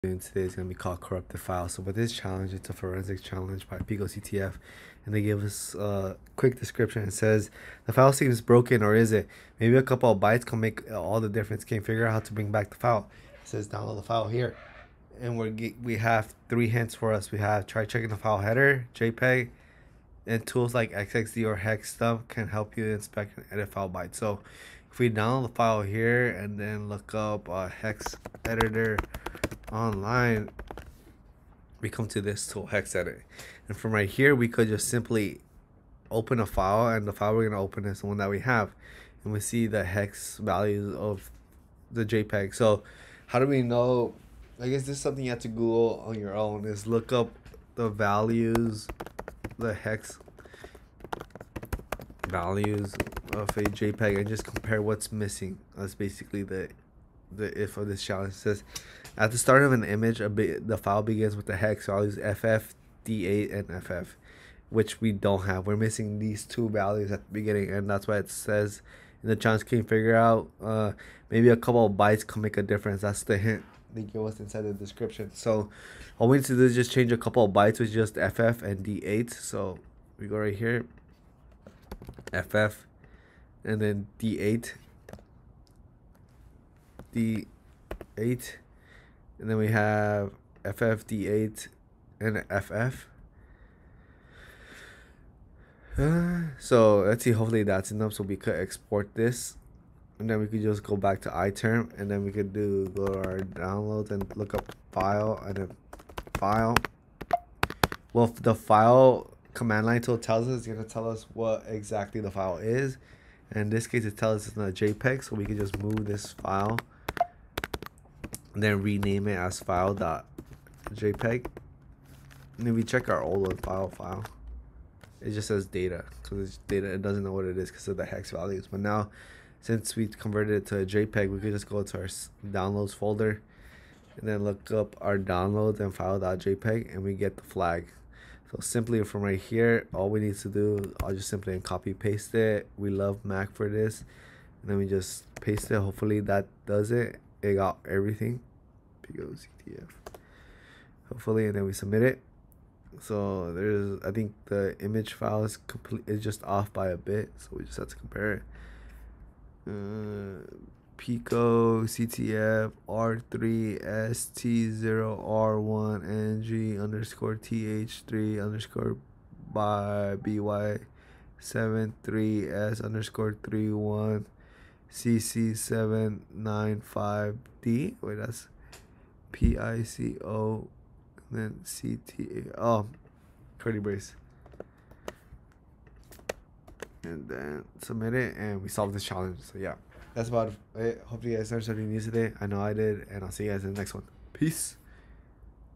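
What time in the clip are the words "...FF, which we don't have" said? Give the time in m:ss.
1:03.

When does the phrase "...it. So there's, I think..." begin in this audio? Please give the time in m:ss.
2:32.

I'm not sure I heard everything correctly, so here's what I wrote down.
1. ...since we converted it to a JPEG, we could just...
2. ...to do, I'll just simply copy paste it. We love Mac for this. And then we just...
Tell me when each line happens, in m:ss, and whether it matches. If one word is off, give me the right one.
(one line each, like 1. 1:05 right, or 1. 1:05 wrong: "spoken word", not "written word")
1. 2:09 right
2. 2:20 right.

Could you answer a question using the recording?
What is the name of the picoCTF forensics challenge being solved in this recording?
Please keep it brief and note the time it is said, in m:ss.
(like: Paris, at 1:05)
Corrupted File, at 0:00.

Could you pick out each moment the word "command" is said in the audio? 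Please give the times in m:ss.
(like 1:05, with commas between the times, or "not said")
1:49.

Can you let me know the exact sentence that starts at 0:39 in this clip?
And we see the hex values of the JPEG.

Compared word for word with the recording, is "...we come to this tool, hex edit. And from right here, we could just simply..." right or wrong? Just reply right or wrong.
right.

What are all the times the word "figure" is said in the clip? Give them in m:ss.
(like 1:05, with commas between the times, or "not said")
0:11, 1:09.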